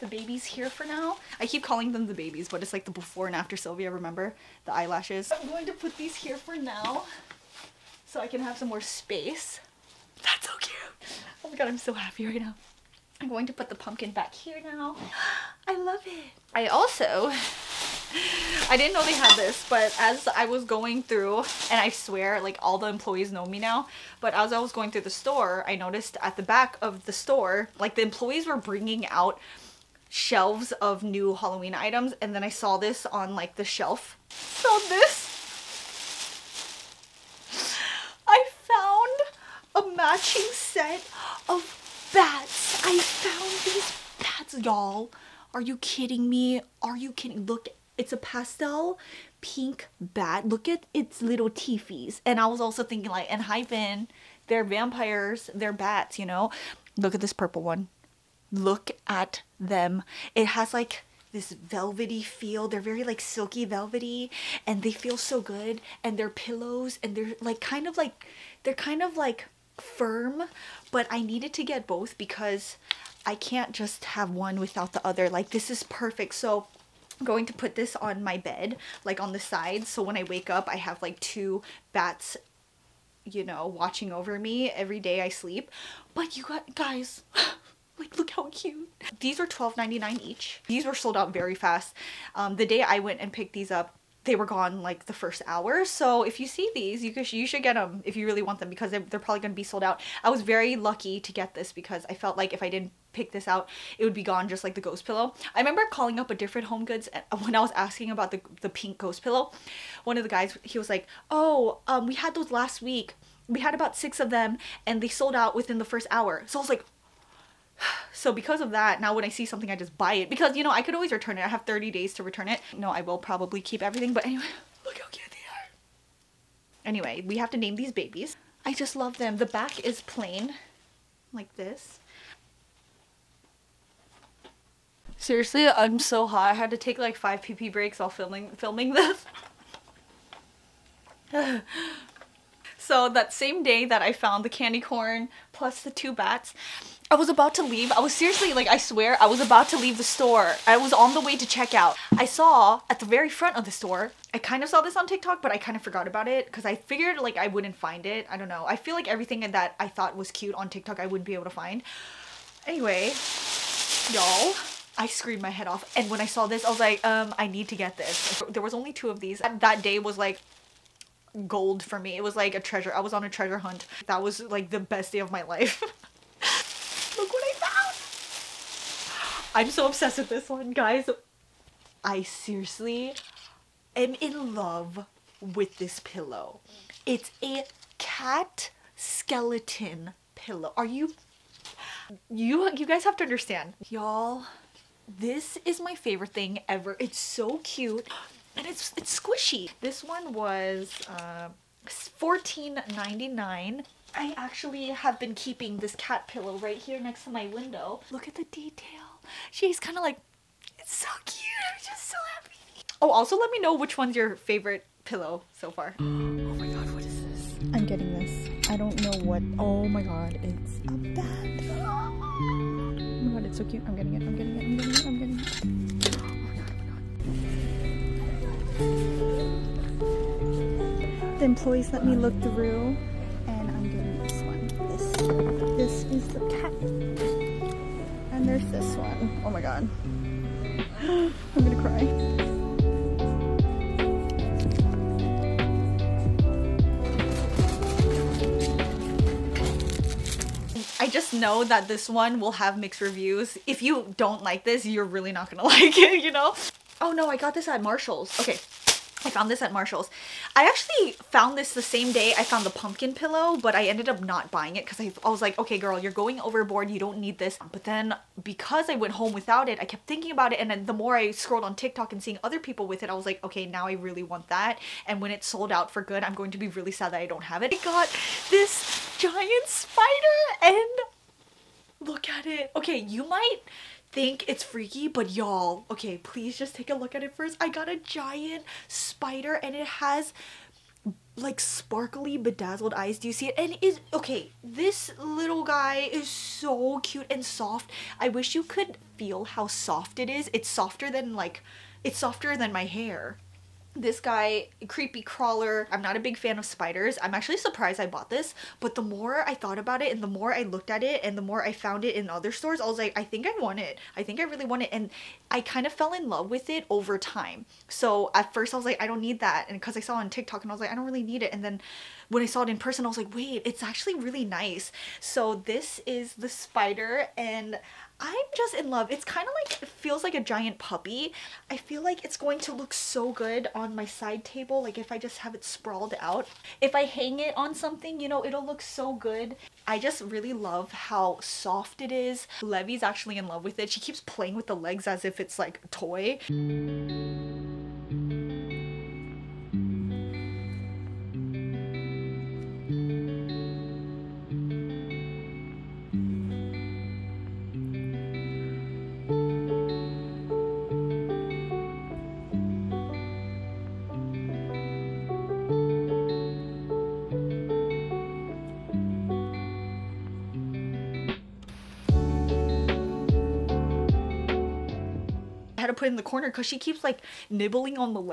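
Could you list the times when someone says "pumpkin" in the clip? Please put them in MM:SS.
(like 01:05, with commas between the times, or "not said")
00:13, 04:22.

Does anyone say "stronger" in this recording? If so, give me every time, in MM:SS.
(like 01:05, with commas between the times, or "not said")
not said.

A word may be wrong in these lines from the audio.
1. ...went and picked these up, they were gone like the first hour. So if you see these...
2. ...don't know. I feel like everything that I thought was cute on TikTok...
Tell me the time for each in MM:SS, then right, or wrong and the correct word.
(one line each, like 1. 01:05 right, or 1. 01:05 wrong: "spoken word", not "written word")
1. 01:32 right
2. 02:38 right.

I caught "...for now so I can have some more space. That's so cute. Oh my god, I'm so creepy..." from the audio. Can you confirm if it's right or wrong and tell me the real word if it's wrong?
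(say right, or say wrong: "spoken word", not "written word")
wrong: "happy", not "creepy".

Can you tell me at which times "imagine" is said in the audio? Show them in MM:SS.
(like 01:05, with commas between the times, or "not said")
not said.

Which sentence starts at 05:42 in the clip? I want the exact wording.
Levy's actually in love with it.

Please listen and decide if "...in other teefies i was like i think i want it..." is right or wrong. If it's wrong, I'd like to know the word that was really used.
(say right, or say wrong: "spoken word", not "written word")
wrong: "stores", not "teefies".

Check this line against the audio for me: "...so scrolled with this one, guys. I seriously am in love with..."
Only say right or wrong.
wrong.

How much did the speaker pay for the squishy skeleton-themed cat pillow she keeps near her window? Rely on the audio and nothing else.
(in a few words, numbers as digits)
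$14.99.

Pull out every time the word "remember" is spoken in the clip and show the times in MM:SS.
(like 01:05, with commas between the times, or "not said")
00:03, 01:45.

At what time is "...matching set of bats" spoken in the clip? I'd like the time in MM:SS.
00:40.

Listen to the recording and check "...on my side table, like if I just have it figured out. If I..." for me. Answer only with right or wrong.
wrong.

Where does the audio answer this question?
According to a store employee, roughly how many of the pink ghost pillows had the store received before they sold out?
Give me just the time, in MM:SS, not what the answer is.
01:53.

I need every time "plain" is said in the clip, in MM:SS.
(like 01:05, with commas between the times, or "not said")
02:10.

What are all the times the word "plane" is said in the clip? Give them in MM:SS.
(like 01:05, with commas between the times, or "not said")
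not said.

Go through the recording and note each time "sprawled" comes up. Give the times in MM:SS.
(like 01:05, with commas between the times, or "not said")
05:35.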